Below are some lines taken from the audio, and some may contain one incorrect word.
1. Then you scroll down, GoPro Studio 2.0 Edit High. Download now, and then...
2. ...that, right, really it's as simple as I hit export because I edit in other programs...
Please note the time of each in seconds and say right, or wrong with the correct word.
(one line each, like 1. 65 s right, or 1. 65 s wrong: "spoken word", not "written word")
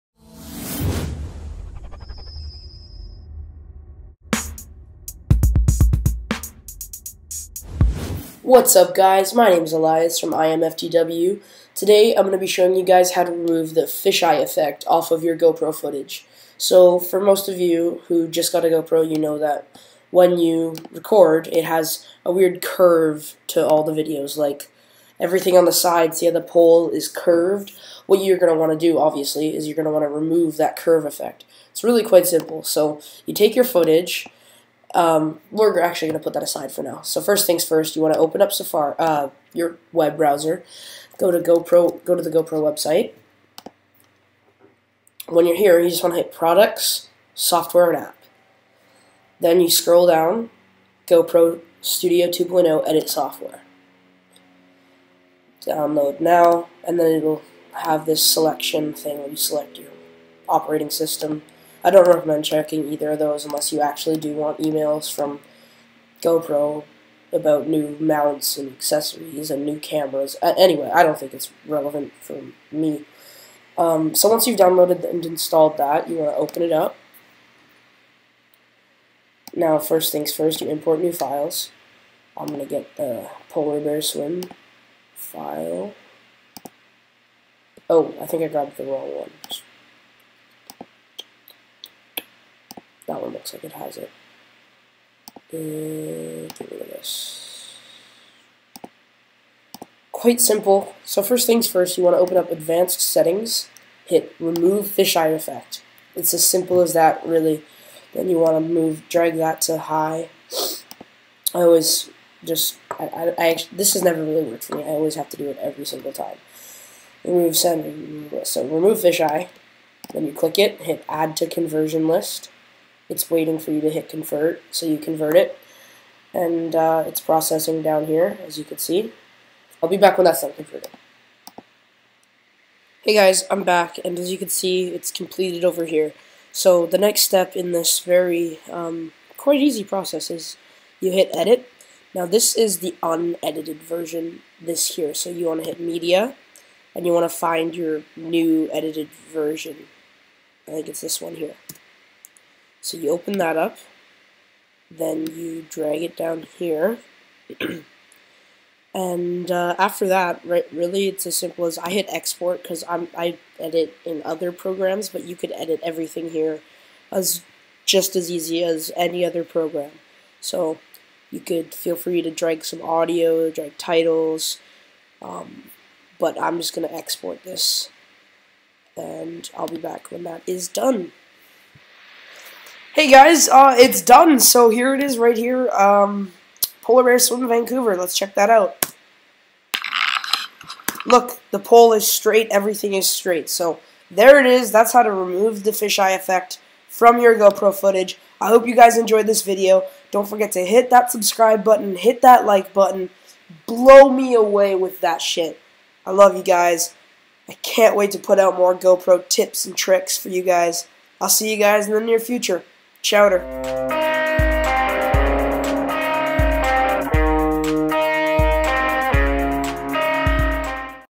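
1. 49 s wrong: "Software", not "High"
2. 160 s right.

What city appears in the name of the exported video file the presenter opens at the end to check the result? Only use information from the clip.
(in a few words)
Vancouver.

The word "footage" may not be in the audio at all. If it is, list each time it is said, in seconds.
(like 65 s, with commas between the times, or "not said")
15 s, 33 s, 197 s.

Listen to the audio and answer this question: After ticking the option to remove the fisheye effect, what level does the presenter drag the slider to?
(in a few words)
High.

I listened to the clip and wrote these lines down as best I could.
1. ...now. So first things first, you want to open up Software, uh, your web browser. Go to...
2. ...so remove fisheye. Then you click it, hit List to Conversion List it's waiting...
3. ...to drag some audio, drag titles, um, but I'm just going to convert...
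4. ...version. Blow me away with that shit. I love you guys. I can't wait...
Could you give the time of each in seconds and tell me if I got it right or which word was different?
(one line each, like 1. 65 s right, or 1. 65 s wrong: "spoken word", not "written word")
1. 36 s wrong: "Safari", not "Software"
2. 118 s wrong: "Add", not "List"
3. 172 s wrong: "export", not "convert"
4. 202 s wrong: "button", not "version".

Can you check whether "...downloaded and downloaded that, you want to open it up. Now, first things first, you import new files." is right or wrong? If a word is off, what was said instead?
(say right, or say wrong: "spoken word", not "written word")
wrong: "installed", not "downloaded".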